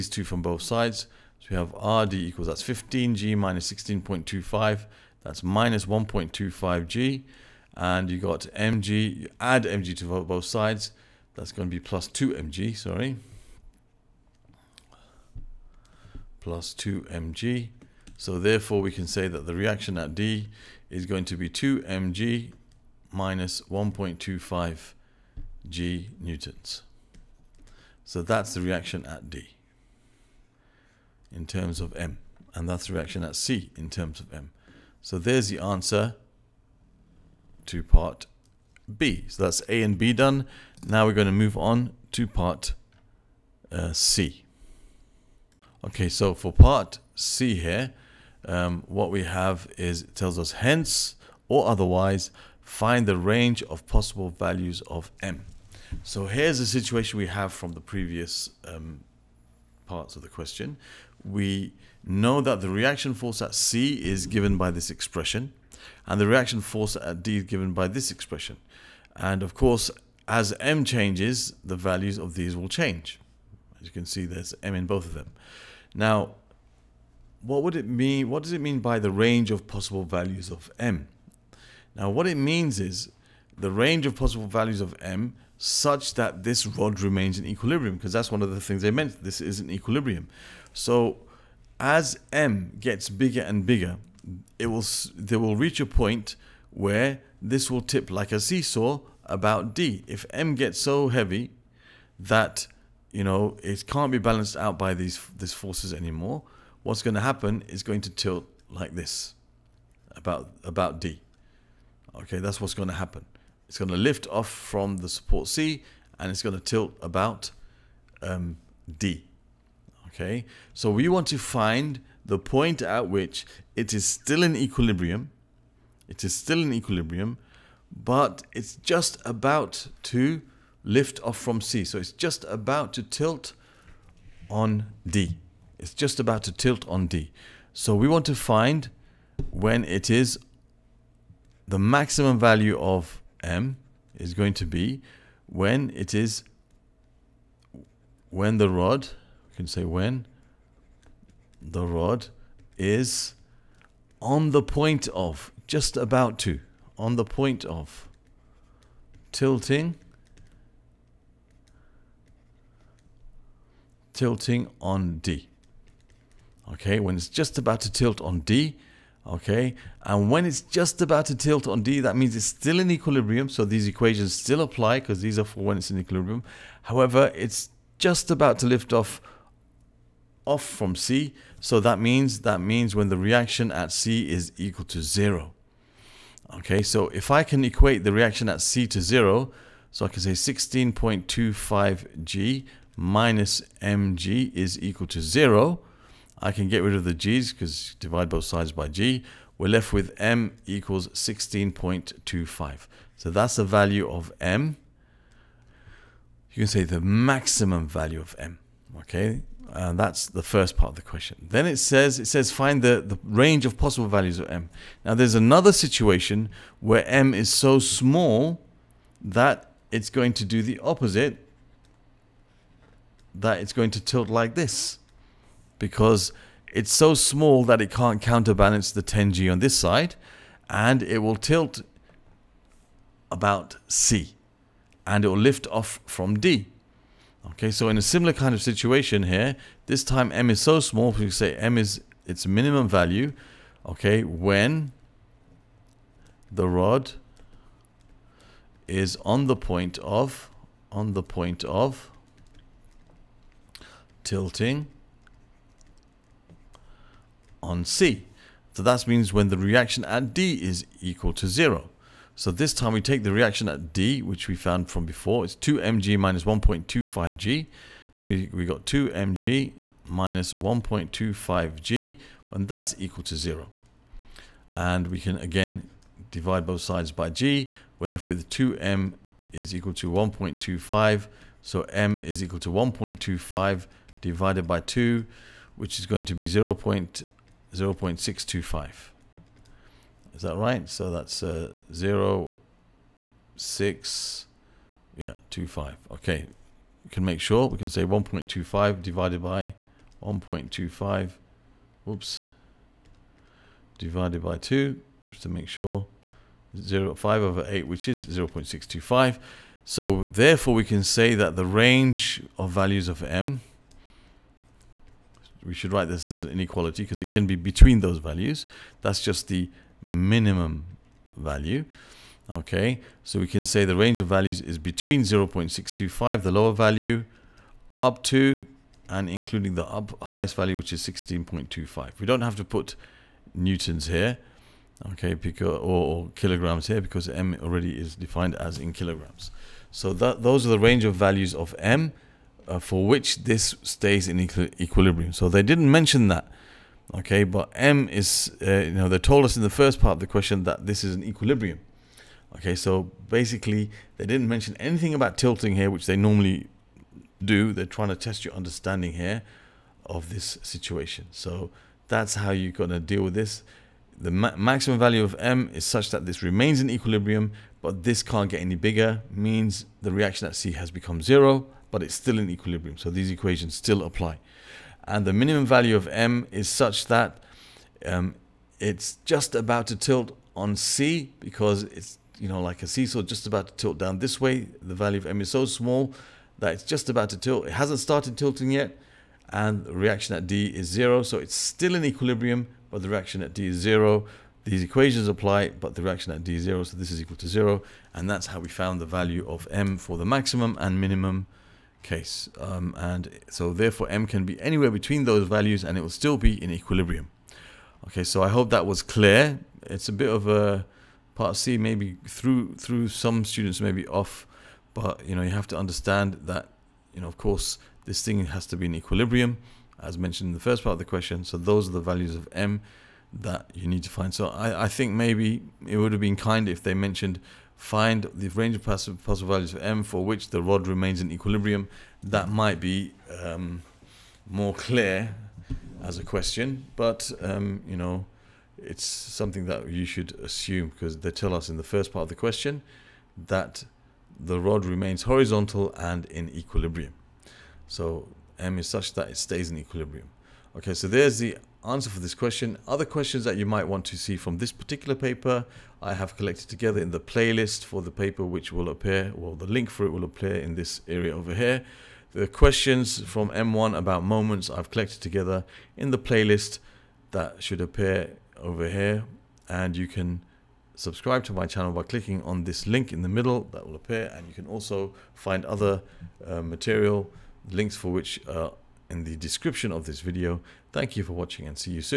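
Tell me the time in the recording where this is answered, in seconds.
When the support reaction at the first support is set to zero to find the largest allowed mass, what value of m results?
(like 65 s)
200 s.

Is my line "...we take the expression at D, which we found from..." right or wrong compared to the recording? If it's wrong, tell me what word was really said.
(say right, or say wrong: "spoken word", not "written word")
wrong: "reaction", not "expression".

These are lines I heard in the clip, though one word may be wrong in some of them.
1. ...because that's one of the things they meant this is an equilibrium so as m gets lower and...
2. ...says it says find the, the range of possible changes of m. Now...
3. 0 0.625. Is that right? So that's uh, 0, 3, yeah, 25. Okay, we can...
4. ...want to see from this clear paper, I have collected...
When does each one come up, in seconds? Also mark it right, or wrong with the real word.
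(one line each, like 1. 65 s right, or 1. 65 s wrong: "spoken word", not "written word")
1. 87 s wrong: "bigger", not "lower"
2. 211 s wrong: "values", not "changes"
3. 287 s wrong: "6", not "3"
4. 453 s wrong: "particular", not "clear".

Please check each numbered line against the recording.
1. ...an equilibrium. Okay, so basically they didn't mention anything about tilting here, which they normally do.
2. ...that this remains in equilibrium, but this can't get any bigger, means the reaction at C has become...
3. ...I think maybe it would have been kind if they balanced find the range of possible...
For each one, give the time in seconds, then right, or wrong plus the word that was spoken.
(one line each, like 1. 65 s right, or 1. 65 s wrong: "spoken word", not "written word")
1. 351 s right
2. 366 s right
3. 424 s wrong: "mentioned", not "balanced".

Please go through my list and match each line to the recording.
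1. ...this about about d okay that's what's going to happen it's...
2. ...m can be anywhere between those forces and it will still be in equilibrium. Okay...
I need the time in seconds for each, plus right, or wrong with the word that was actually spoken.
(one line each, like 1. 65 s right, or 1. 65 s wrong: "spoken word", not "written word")
1. 108 s right
2. 404 s wrong: "values", not "forces".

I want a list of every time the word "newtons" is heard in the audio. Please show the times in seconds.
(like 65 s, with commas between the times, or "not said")
26 s, 333 s.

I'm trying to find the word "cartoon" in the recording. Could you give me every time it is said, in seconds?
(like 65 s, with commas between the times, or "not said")
not said.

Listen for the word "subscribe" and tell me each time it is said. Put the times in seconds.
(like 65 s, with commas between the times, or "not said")
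470 s.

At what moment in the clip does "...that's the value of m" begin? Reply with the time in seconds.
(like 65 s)
203 s.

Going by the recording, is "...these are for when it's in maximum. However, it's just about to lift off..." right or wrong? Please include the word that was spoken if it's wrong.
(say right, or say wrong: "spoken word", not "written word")
wrong: "equilibrium", not "maximum".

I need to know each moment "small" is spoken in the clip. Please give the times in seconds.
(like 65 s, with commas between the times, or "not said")
217 s, 227 s, 240 s, 385 s.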